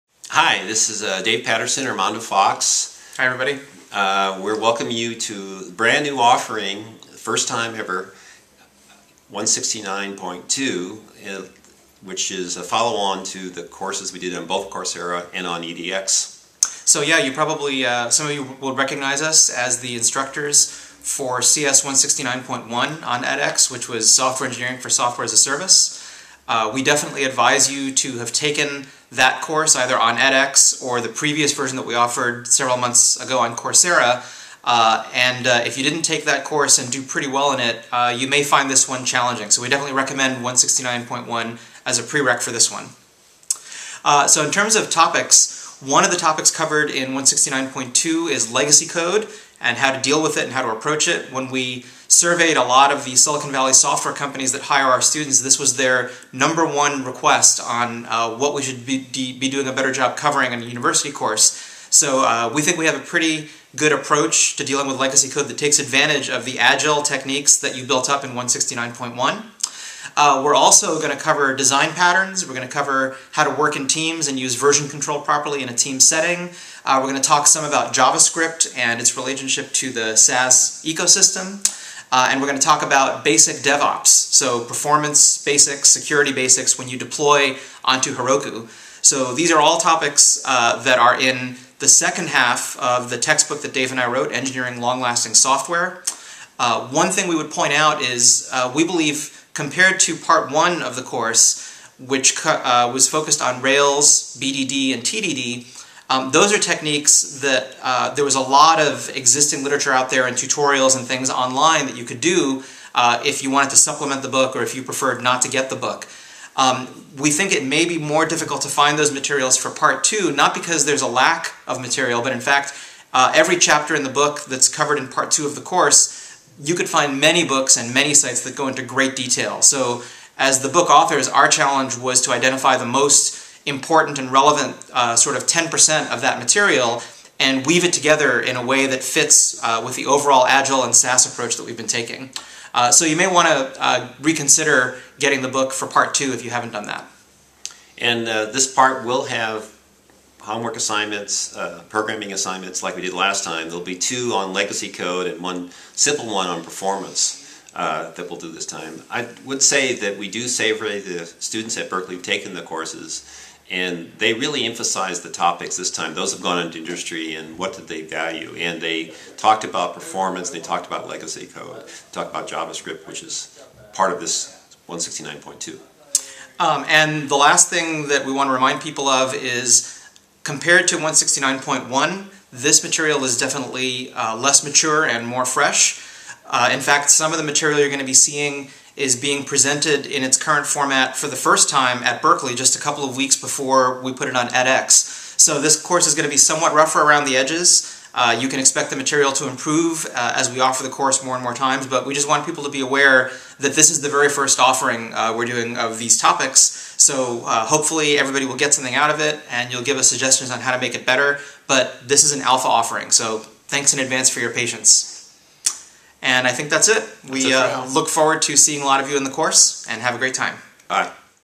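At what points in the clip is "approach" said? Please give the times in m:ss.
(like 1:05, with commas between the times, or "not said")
0:50, 1:03, 2:21.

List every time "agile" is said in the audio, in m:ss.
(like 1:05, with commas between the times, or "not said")
1:06, 2:20.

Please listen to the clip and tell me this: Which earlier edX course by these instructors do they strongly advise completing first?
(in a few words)
Software Engineering for Software as a Service.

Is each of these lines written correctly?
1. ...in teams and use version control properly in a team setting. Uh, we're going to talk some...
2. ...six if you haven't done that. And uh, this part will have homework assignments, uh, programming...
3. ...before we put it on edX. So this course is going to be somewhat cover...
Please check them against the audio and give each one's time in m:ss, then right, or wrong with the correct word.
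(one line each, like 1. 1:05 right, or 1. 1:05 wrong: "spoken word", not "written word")
1. 1:13 right
2. 2:26 wrong: "two", not "six"
3. 3:13 wrong: "rougher", not "cover".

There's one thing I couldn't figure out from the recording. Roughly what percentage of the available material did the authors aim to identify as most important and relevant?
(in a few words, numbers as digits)
10%.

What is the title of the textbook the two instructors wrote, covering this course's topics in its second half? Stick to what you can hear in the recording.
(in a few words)
Engineering Long-Lasting Software.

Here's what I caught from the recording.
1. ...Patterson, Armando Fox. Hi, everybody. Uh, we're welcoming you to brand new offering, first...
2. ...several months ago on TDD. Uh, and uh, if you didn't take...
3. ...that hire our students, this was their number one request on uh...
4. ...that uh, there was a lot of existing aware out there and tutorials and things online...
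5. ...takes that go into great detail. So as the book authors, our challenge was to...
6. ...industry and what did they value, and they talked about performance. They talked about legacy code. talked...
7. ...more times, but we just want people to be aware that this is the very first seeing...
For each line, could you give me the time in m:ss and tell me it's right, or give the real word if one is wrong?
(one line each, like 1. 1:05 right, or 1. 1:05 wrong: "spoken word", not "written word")
1. 0:01 right
2. 0:32 wrong: "Coursera", not "TDD"
3. 0:54 right
4. 1:47 wrong: "literature", not "aware"
5. 2:08 wrong: "sites", not "takes"
6. 2:46 right
7. 3:21 wrong: "offering", not "seeing".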